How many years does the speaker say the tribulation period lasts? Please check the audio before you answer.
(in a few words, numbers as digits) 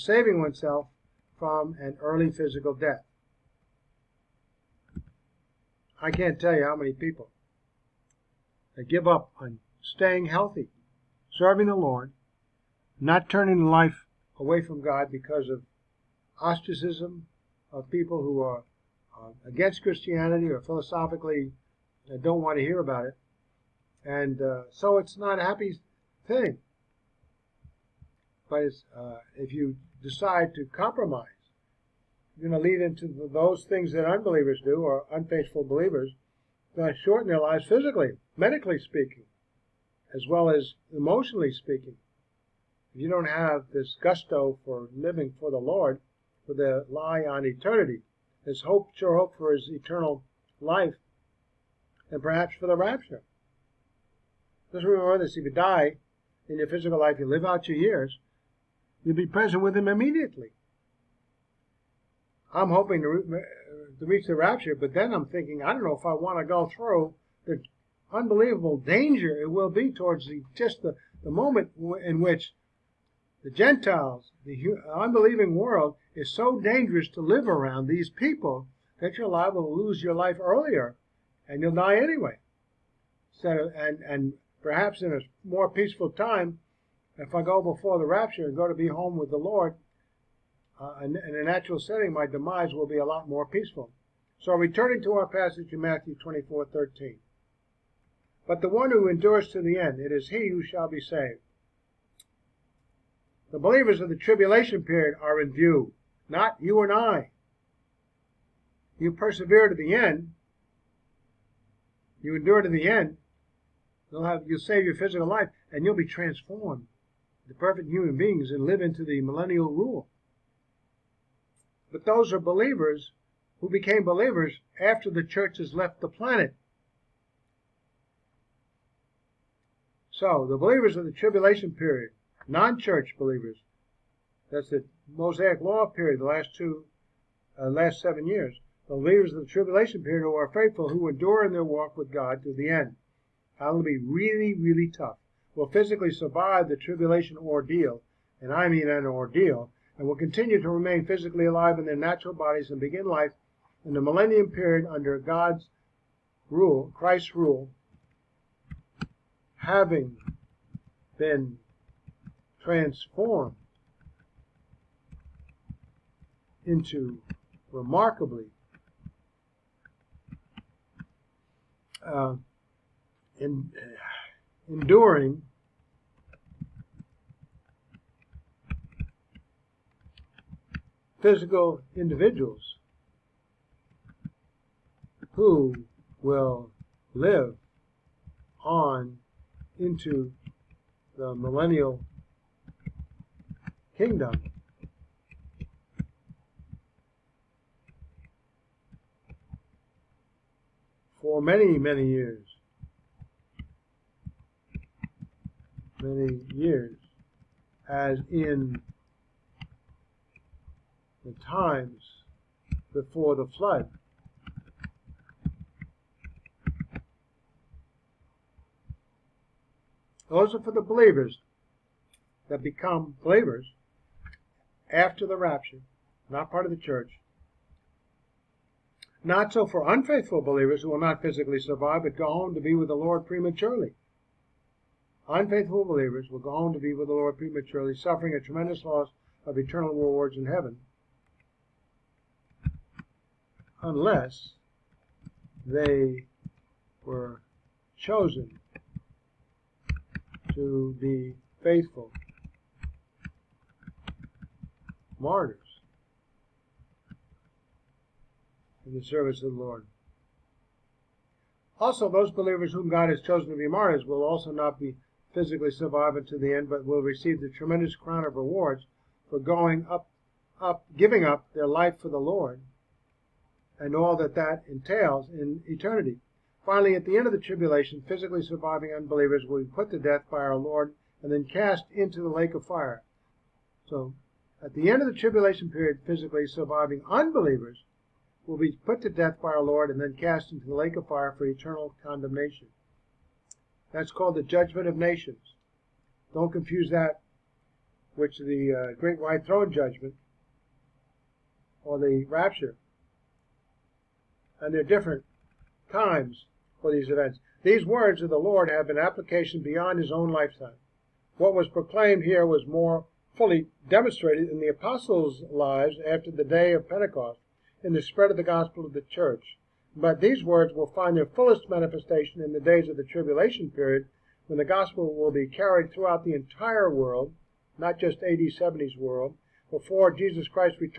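7.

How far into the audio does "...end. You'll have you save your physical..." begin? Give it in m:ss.
1:52.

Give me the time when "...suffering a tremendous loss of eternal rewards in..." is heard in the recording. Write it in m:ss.
3:57.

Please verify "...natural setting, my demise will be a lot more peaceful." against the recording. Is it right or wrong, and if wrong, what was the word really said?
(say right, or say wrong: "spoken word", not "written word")
right.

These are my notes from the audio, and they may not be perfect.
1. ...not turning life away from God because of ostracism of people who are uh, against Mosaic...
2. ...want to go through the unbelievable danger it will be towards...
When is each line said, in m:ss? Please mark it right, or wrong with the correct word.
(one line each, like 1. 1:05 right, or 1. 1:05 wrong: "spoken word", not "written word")
1. 0:12 wrong: "Christianity", not "Mosaic"
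2. 1:06 right.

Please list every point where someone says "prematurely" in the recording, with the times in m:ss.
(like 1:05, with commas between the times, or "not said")
3:53, 3:57.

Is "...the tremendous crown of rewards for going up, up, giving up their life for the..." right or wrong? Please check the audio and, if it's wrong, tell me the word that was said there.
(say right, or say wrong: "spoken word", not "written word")
right.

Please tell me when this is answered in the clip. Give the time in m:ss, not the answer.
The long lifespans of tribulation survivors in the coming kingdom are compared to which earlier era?
3:32.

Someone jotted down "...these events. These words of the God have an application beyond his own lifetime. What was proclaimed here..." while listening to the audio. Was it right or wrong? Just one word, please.
wrong.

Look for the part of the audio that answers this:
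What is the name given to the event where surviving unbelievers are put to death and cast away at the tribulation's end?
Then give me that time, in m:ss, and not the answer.
4:54.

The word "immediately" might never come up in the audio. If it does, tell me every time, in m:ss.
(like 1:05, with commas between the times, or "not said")
0:59.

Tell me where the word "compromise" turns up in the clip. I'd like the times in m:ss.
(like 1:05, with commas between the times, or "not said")
0:30.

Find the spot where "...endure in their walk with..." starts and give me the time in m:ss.
2:21.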